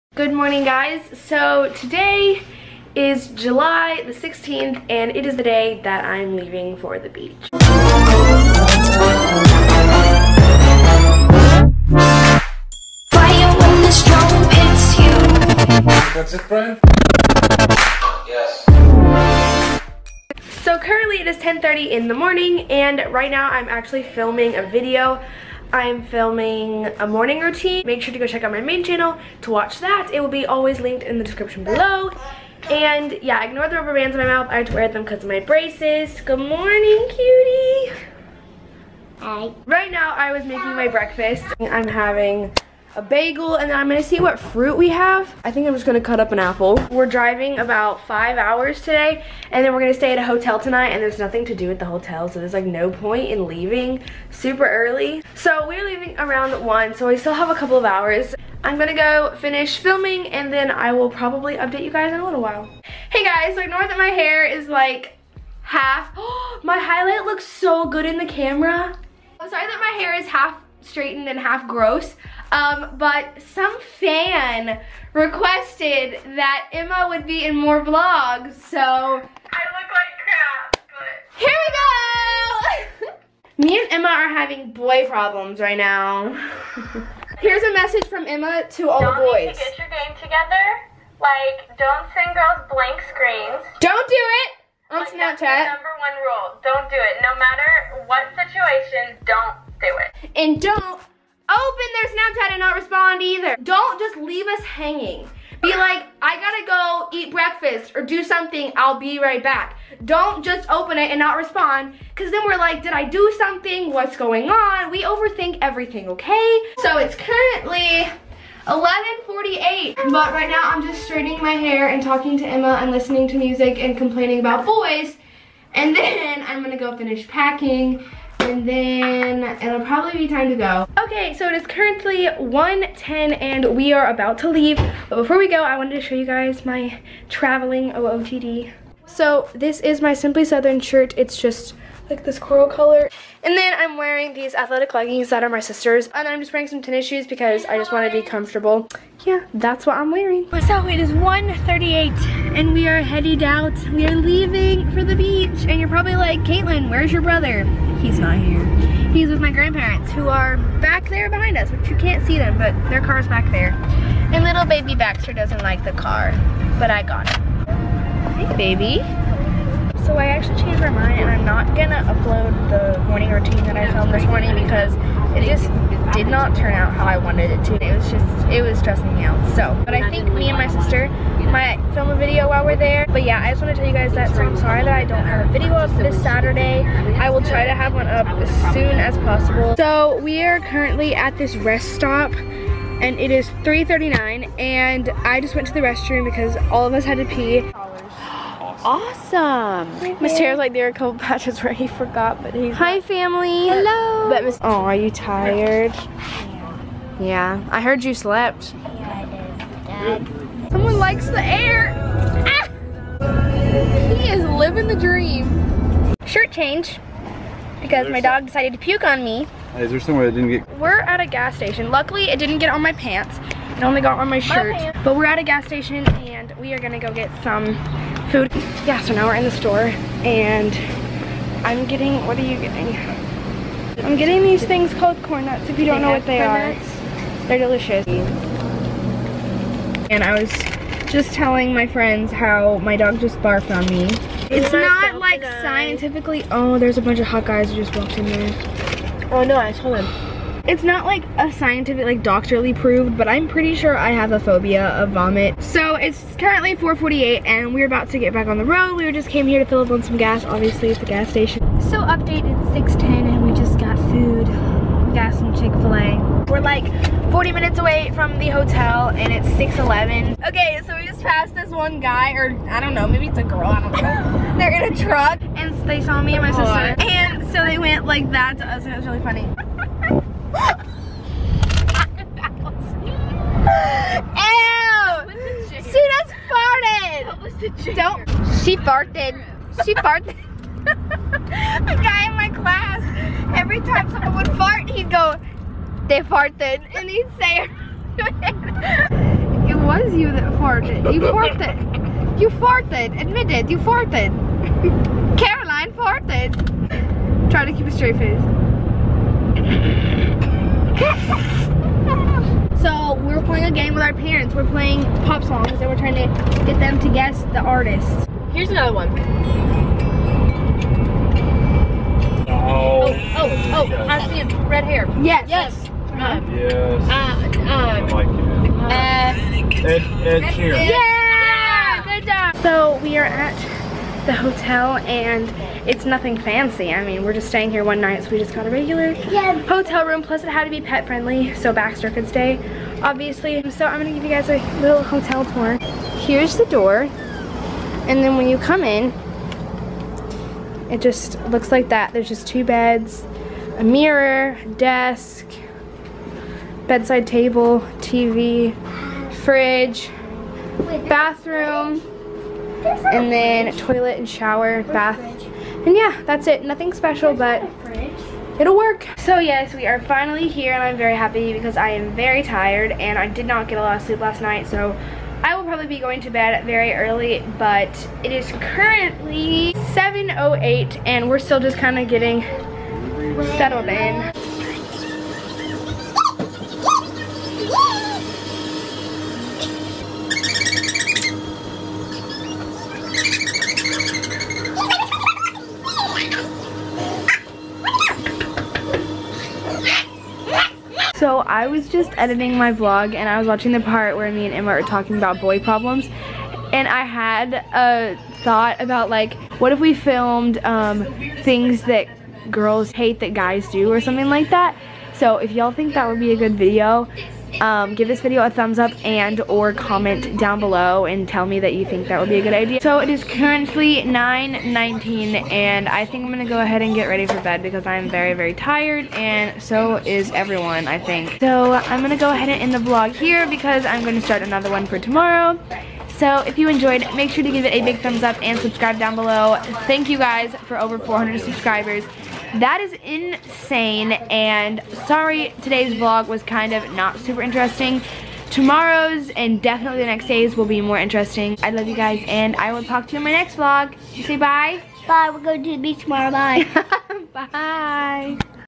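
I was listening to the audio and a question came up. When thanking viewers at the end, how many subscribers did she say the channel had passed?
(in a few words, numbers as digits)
400.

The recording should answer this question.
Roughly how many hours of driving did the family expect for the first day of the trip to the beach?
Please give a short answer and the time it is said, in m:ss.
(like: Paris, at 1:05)
5, at 0:47.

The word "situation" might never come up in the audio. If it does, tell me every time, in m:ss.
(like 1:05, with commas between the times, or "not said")
1:38.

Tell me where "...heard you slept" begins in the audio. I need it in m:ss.
3:27.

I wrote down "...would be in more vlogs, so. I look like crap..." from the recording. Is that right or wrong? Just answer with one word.
right.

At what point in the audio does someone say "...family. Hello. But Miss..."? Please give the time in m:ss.
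3:23.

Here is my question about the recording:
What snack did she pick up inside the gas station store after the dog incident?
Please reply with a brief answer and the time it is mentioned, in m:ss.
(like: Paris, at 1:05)
Corn nuts, at 3:55.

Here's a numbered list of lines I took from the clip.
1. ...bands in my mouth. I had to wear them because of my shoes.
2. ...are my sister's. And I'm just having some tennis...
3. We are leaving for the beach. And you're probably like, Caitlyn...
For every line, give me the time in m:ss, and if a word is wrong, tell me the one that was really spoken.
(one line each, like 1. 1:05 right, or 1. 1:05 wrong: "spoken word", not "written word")
1. 0:33 wrong: "braces", not "shoes"
2. 2:25 wrong: "wearing", not "having"
3. 2:33 right.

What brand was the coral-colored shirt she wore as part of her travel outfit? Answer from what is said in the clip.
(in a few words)
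Simply Southern.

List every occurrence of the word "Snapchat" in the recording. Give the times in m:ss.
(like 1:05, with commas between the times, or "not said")
1:35, 1:42.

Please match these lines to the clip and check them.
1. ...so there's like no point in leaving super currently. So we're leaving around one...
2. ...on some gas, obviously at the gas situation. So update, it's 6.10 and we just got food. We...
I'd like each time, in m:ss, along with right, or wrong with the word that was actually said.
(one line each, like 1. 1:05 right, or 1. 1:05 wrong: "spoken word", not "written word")
1. 0:52 wrong: "early", not "currently"
2. 4:19 wrong: "station", not "situation".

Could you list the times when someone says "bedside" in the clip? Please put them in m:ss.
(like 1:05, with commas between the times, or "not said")
5:56.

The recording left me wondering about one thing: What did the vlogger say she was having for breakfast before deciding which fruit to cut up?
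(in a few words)
A bagel.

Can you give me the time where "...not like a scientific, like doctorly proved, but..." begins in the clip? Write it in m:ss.
4:10.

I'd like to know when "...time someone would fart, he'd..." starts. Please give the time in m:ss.
4:53.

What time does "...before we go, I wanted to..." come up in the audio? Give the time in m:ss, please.
2:15.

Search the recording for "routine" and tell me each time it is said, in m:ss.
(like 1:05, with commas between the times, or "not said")
0:27, 2:53.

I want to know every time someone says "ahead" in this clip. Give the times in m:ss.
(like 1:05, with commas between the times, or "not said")
7:06, 7:12.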